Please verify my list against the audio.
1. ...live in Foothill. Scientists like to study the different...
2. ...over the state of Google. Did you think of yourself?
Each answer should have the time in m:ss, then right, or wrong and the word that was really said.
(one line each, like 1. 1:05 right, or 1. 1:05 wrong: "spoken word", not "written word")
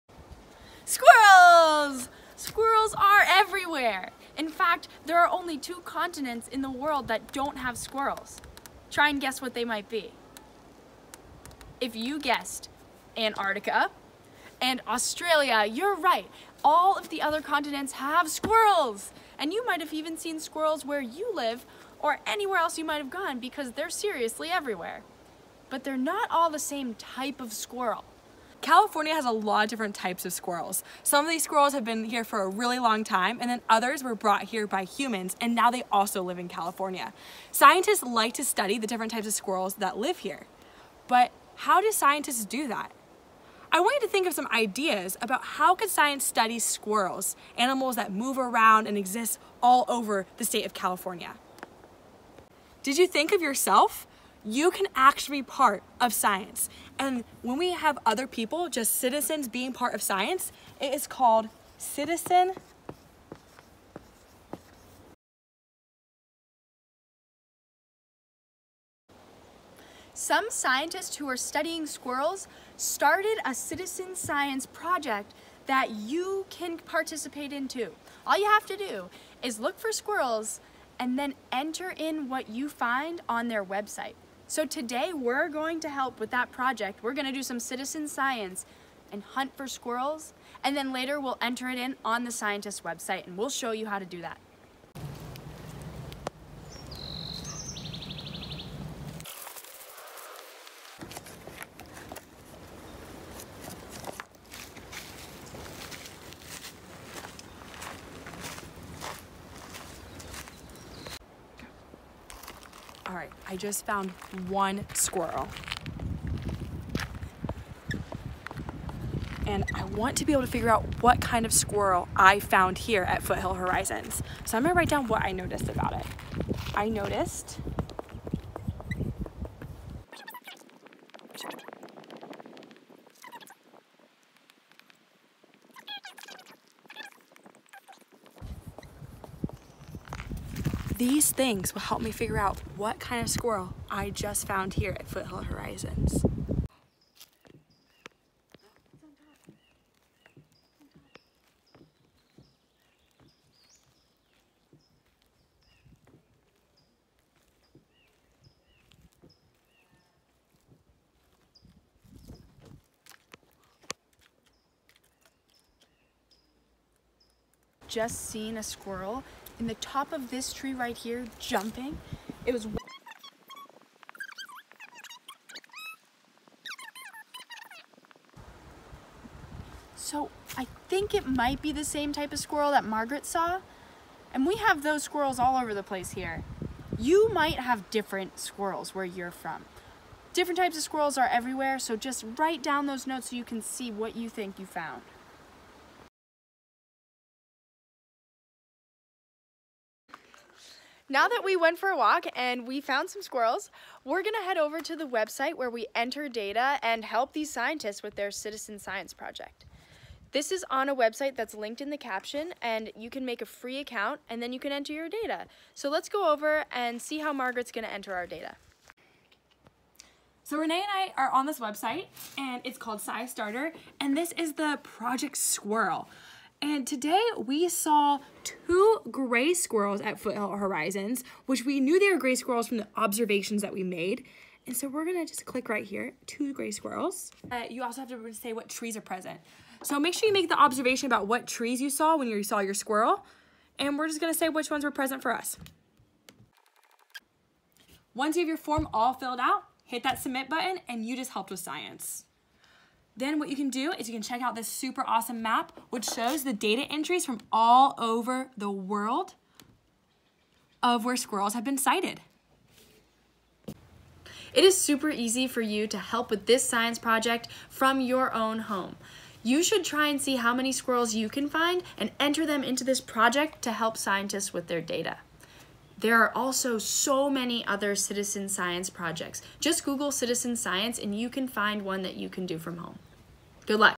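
1. 0:36 wrong: "California", not "Foothill"
2. 0:49 wrong: "California", not "Google".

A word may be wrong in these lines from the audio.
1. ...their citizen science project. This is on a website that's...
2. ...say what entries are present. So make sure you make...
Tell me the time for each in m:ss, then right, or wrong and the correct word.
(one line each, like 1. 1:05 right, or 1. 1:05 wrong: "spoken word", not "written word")
1. 3:28 right
2. 3:58 wrong: "trees", not "entries".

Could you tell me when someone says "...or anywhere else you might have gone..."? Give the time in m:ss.
0:22.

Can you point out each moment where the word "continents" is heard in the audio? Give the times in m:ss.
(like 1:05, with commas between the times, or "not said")
0:05, 0:17.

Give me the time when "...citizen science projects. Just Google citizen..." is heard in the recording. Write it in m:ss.
4:37.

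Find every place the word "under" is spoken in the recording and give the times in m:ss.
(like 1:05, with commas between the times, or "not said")
not said.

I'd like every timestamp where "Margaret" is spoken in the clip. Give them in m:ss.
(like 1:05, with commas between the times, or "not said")
3:02, 3:37.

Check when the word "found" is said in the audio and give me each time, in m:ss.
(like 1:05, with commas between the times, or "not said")
1:53, 2:02, 2:24, 3:14, 3:22.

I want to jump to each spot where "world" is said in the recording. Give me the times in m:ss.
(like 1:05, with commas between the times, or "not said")
0:06, 4:18.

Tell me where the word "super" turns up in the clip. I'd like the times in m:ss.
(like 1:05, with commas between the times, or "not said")
4:14, 4:24.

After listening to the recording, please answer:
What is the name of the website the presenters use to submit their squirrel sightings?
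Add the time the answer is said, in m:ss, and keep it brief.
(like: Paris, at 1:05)
SciStarter, at 3:43.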